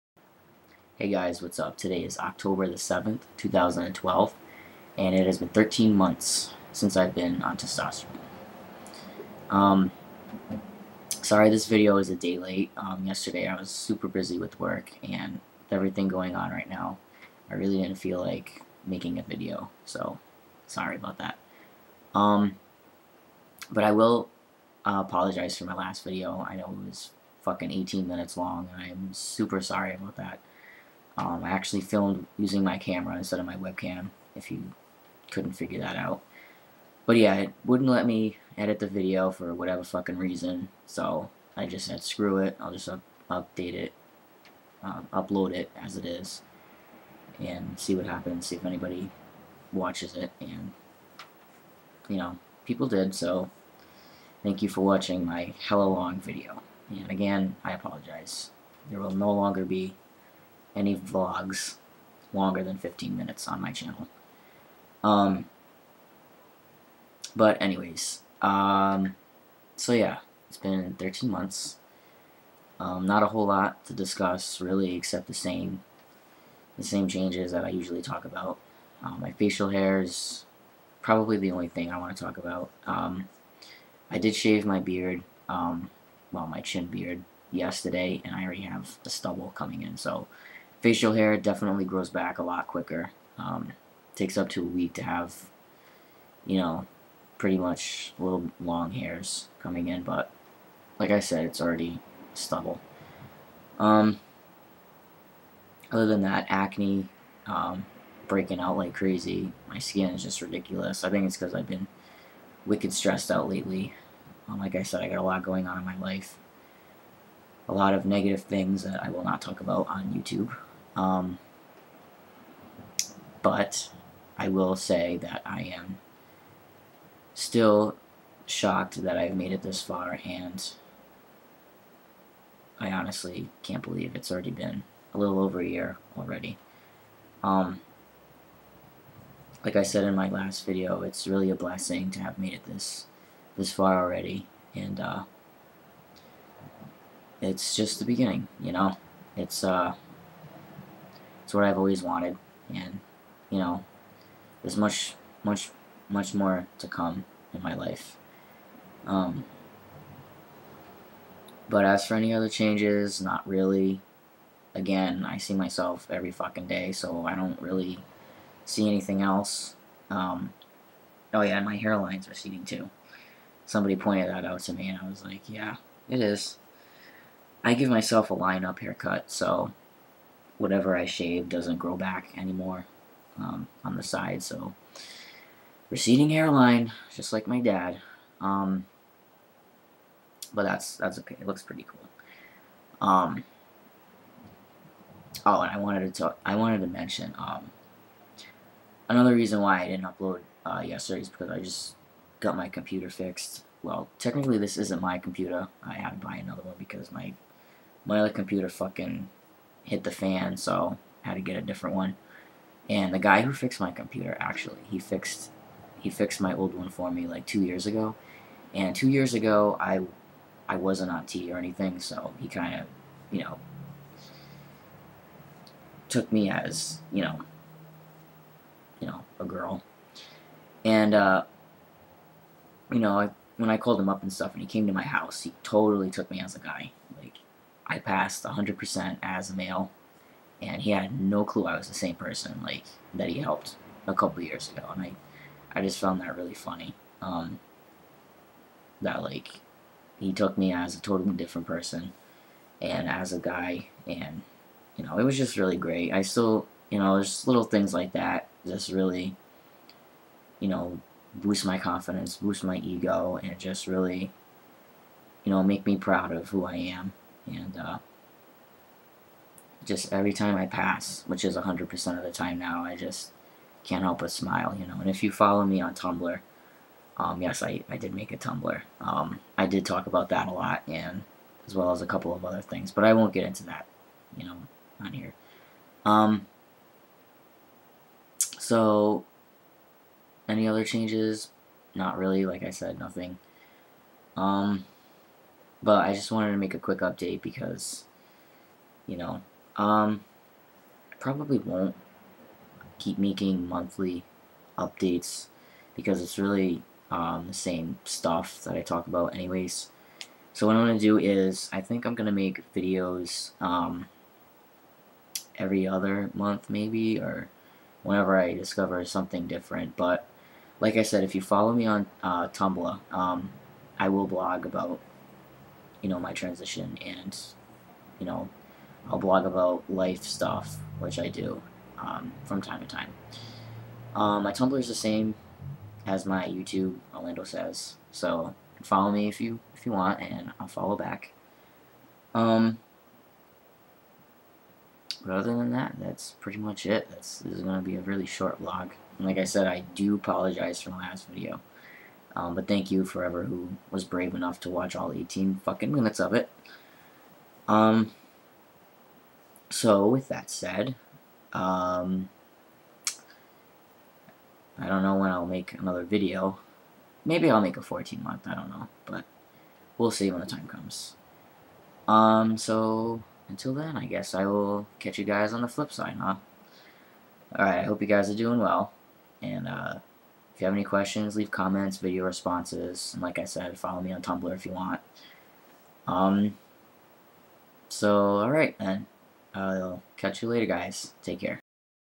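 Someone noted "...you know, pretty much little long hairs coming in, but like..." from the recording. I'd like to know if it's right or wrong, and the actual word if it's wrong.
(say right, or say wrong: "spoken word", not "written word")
right.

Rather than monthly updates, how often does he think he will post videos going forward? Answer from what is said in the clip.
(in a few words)
every other month.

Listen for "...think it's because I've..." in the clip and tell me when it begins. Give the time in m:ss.
1:51.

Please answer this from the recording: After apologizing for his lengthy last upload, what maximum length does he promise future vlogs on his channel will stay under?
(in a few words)
15 minutes.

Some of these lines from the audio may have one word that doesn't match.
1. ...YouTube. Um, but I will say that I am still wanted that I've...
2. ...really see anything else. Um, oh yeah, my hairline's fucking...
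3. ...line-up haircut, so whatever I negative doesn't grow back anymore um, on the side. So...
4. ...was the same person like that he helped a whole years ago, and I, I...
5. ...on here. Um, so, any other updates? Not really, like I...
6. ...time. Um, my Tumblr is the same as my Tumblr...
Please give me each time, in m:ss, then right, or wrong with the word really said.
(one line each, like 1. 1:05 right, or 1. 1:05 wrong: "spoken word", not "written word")
1. 2:00 wrong: "shocked", not "wanted"
2. 2:47 wrong: "receding", not "fucking"
3. 2:58 wrong: "shave", not "negative"
4. 4:01 wrong: "couple", not "whole"
5. 4:45 wrong: "changes", not "updates"
6. 5:32 wrong: "YouTube", not "Tumblr".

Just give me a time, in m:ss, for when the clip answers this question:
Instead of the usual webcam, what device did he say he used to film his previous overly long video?
0:32.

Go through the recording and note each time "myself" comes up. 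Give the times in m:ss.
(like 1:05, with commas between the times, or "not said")
2:45, 2:57.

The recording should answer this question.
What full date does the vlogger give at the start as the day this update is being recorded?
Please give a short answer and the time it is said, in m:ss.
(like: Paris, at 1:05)
October 7, 2012, at 0:02.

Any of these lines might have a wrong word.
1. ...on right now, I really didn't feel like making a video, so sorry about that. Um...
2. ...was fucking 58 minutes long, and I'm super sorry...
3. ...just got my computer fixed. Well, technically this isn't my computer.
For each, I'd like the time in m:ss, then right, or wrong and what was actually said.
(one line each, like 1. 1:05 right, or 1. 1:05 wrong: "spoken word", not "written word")
1. 0:16 right
2. 0:26 wrong: "18", not "58"
3. 3:21 right.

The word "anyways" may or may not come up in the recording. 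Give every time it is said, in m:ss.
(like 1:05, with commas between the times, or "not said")
1:07, 5:09.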